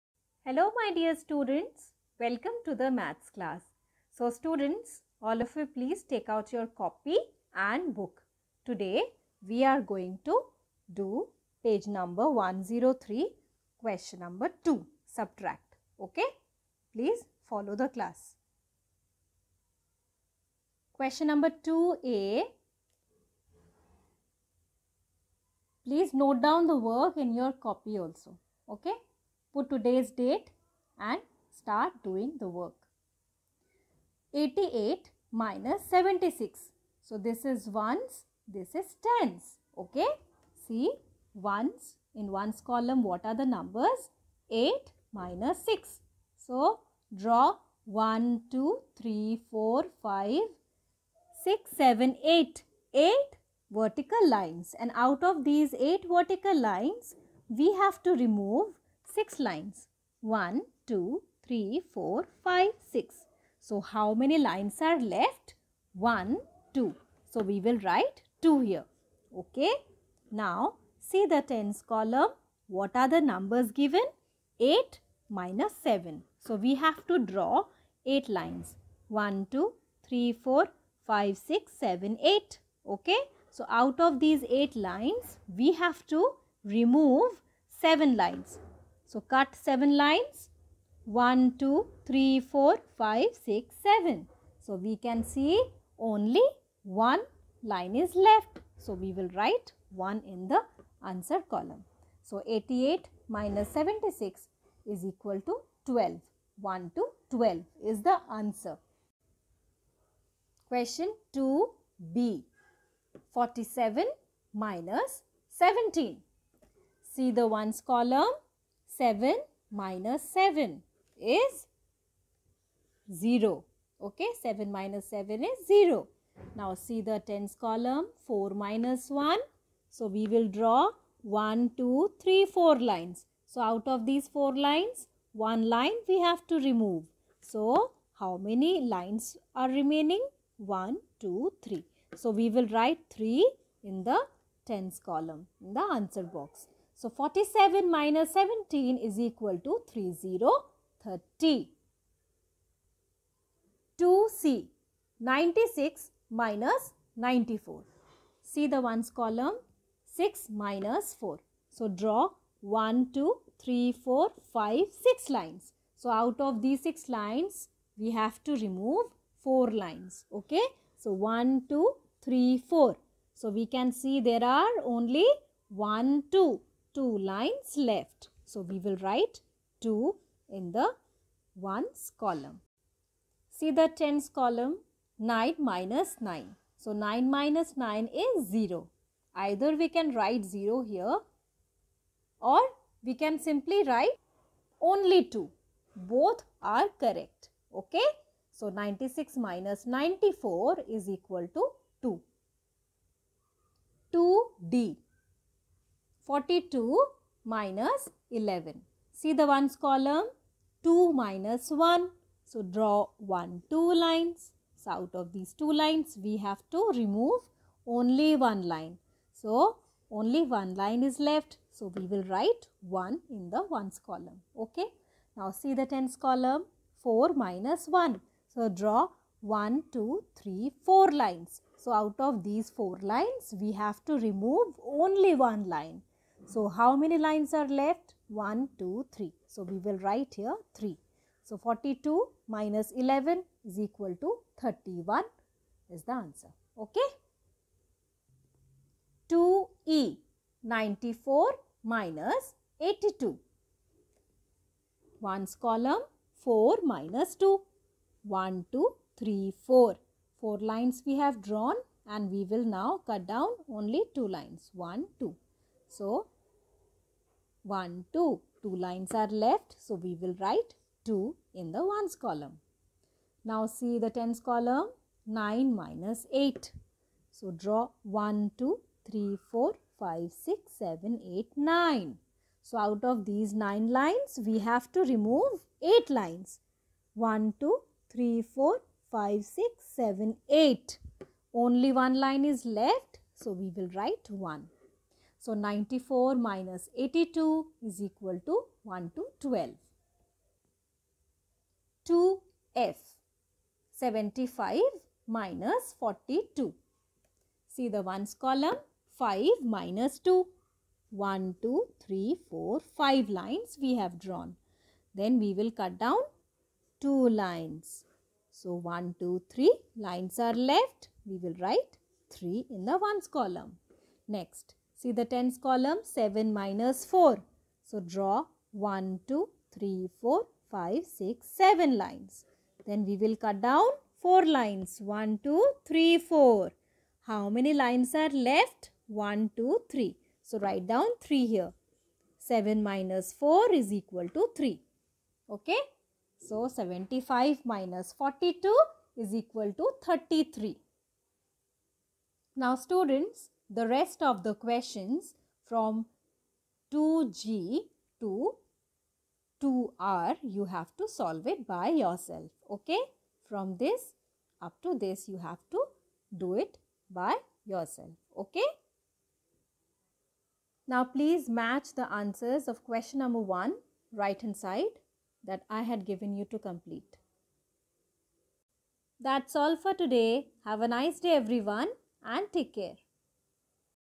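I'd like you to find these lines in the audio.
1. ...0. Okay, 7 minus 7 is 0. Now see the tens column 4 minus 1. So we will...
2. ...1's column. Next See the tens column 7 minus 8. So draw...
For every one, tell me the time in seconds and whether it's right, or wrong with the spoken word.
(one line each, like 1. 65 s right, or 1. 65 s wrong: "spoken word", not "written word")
1. 123 s right
2. 323 s wrong: "4", not "8".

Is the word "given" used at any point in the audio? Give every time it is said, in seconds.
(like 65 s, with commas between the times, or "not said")
73 s, 376 s.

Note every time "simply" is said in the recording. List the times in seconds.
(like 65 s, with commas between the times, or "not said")
193 s.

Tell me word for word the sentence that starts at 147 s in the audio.
So 47 minus 17 is equal to 3030.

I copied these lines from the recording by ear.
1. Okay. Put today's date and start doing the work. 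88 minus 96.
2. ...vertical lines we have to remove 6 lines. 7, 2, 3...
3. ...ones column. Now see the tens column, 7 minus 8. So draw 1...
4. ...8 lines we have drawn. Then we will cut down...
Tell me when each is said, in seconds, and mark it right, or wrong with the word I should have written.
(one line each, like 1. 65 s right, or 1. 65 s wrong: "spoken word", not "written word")
1. 28 s wrong: "76", not "96"
2. 56 s wrong: "1", not "7"
3. 271 s wrong: "9", not "7"
4. 312 s wrong: "5", not "8".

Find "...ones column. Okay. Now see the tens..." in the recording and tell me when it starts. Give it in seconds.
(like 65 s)
223 s.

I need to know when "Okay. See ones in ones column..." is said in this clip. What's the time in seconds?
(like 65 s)
39 s.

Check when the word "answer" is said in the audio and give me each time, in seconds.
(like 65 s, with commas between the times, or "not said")
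101 s, 108 s, 145 s, 246 s, 372 s.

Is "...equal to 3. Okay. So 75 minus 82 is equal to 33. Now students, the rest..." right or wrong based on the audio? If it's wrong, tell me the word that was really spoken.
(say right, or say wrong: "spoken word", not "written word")
wrong: "42", not "82".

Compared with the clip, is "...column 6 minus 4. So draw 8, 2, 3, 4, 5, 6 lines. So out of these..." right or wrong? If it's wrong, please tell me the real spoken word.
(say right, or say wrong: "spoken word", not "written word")
wrong: "1", not "8".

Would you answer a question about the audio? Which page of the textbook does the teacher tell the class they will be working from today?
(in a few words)
103.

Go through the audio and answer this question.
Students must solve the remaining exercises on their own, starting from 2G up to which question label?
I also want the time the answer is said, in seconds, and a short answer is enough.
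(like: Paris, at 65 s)
2R, at 359 s.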